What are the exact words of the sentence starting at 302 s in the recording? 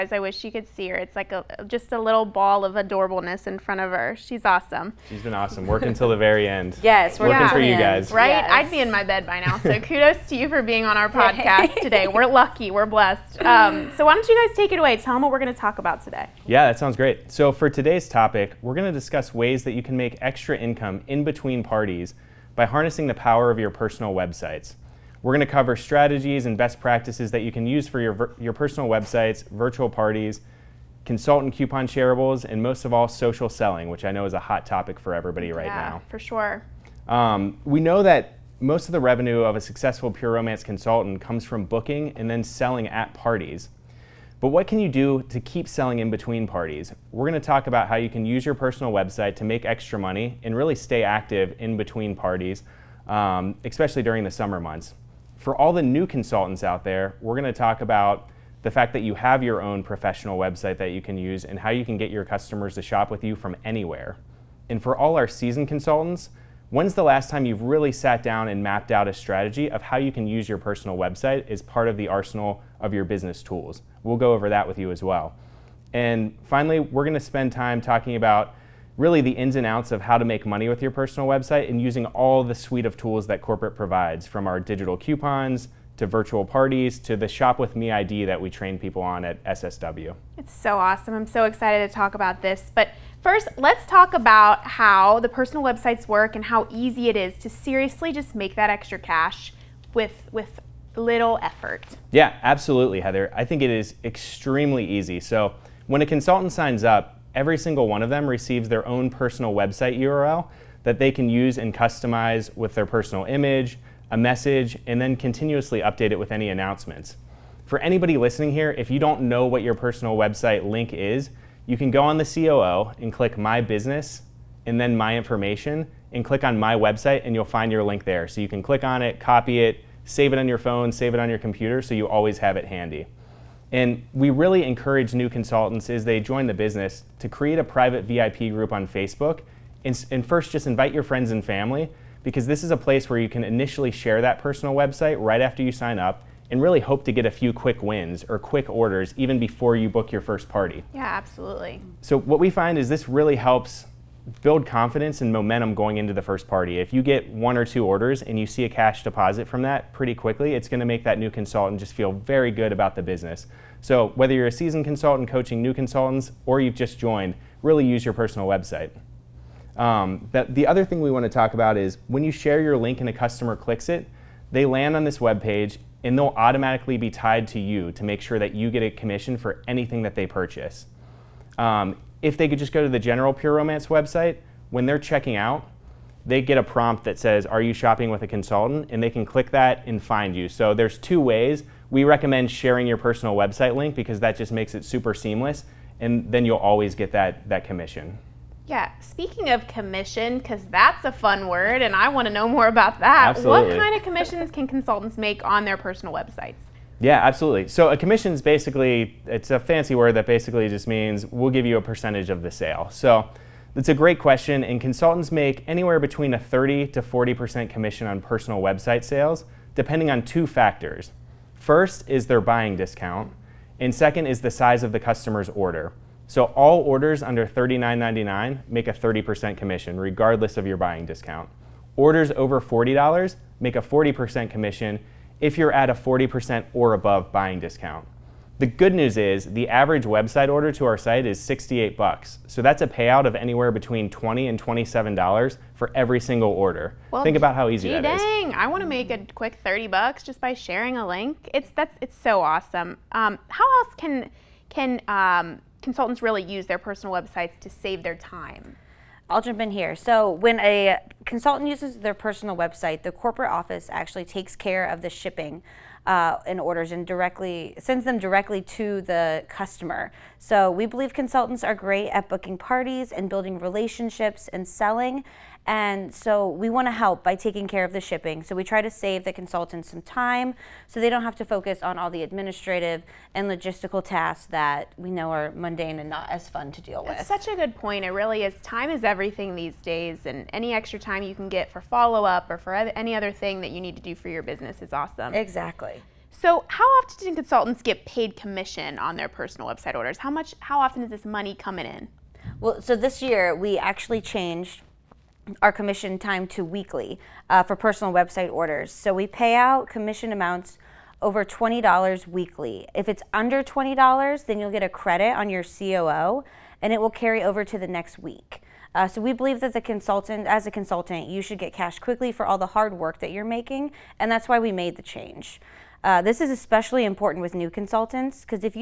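Well, so this year we actually changed our commission time to weekly uh, for personal website orders.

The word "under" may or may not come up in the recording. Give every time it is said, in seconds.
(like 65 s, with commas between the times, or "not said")
227 s, 313 s.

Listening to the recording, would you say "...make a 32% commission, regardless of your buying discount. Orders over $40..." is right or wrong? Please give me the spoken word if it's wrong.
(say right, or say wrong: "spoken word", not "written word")
wrong: "30", not "32".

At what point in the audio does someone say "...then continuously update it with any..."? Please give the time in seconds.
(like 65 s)
114 s.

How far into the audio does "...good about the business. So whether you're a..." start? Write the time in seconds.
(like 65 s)
162 s.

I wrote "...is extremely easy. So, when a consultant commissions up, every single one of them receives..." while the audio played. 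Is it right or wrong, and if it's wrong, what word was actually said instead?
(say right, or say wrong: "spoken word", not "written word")
wrong: "signs", not "commissions".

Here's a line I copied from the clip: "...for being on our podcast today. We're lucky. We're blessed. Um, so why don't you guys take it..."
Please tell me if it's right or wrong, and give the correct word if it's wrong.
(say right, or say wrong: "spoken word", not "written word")
right.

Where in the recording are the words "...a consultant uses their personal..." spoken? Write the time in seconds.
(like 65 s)
260 s.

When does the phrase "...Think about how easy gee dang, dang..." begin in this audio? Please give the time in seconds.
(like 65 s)
247 s.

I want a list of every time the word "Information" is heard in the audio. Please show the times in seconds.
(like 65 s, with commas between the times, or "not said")
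125 s.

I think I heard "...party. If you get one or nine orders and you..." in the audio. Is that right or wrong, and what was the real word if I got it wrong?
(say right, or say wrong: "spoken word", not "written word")
wrong: "two", not "nine".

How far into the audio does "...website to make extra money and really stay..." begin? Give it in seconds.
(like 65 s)
48 s.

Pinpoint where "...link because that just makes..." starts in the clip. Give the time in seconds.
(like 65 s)
193 s.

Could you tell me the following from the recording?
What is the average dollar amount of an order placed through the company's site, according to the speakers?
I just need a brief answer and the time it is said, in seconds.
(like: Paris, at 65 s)
$68, at 241 s.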